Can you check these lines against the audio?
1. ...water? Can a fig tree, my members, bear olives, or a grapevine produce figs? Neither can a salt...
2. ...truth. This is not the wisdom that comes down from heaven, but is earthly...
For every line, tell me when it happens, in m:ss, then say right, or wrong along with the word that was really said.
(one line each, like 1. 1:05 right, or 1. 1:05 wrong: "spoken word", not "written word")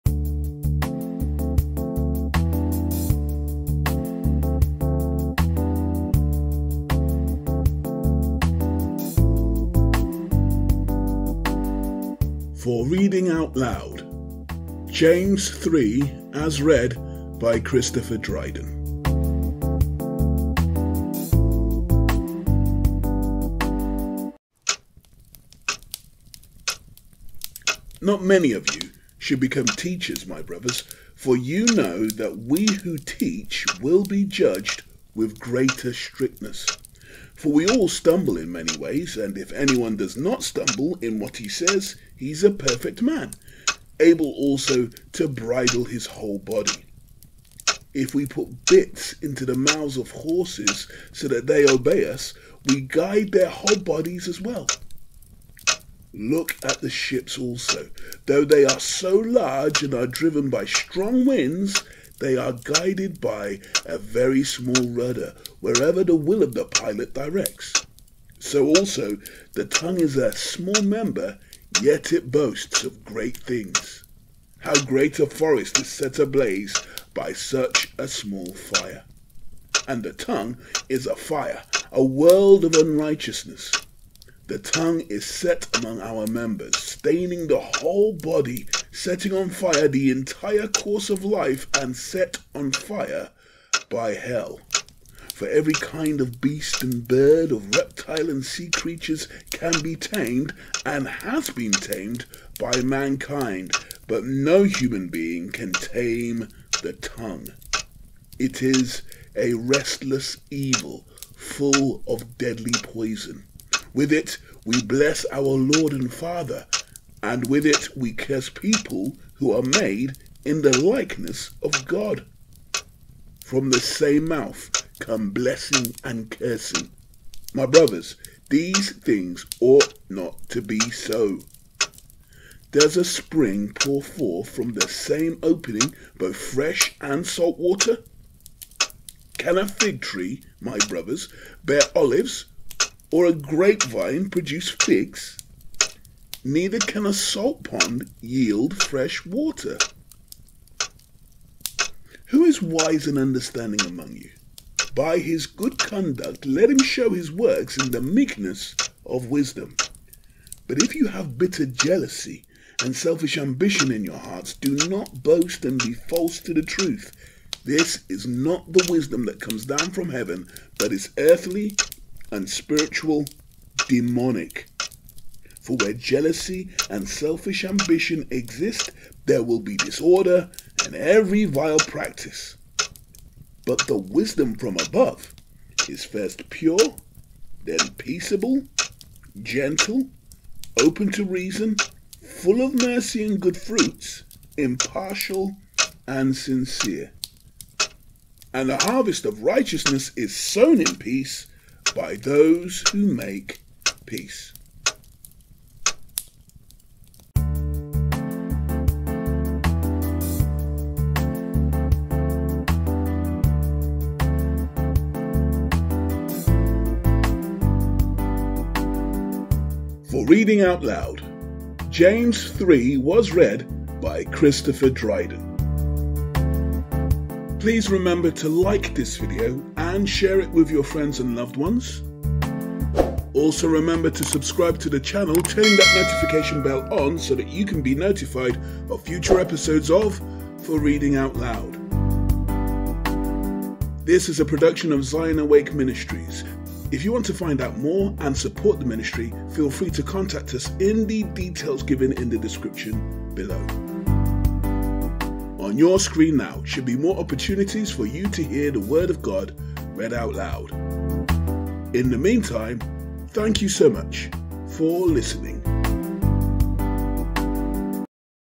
1. 2:17 wrong: "brothers", not "members"
2. 2:46 right.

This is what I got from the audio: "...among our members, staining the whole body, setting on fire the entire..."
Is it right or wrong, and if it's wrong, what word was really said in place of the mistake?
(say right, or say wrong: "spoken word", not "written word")
right.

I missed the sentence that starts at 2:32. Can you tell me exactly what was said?
Who is wise and understanding among you?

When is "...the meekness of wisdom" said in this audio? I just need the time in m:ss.
2:37.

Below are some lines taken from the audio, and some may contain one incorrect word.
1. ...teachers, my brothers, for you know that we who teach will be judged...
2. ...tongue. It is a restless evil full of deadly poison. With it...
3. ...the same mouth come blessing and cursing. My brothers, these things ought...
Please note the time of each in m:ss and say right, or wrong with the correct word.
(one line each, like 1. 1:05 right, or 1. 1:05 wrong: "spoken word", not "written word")
1. 0:29 right
2. 1:47 right
3. 2:03 right.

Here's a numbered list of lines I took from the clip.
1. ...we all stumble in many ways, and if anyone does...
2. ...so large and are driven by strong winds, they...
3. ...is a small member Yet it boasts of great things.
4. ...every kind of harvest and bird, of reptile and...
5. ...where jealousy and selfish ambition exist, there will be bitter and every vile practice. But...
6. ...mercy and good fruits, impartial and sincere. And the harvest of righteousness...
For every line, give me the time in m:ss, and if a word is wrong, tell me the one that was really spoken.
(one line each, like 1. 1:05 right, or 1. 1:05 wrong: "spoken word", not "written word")
1. 0:37 right
2. 0:58 right
3. 1:09 right
4. 1:35 wrong: "beast", not "harvest"
5. 2:55 wrong: "disorder", not "bitter"
6. 3:12 right.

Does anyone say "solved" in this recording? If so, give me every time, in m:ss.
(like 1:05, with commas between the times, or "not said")
not said.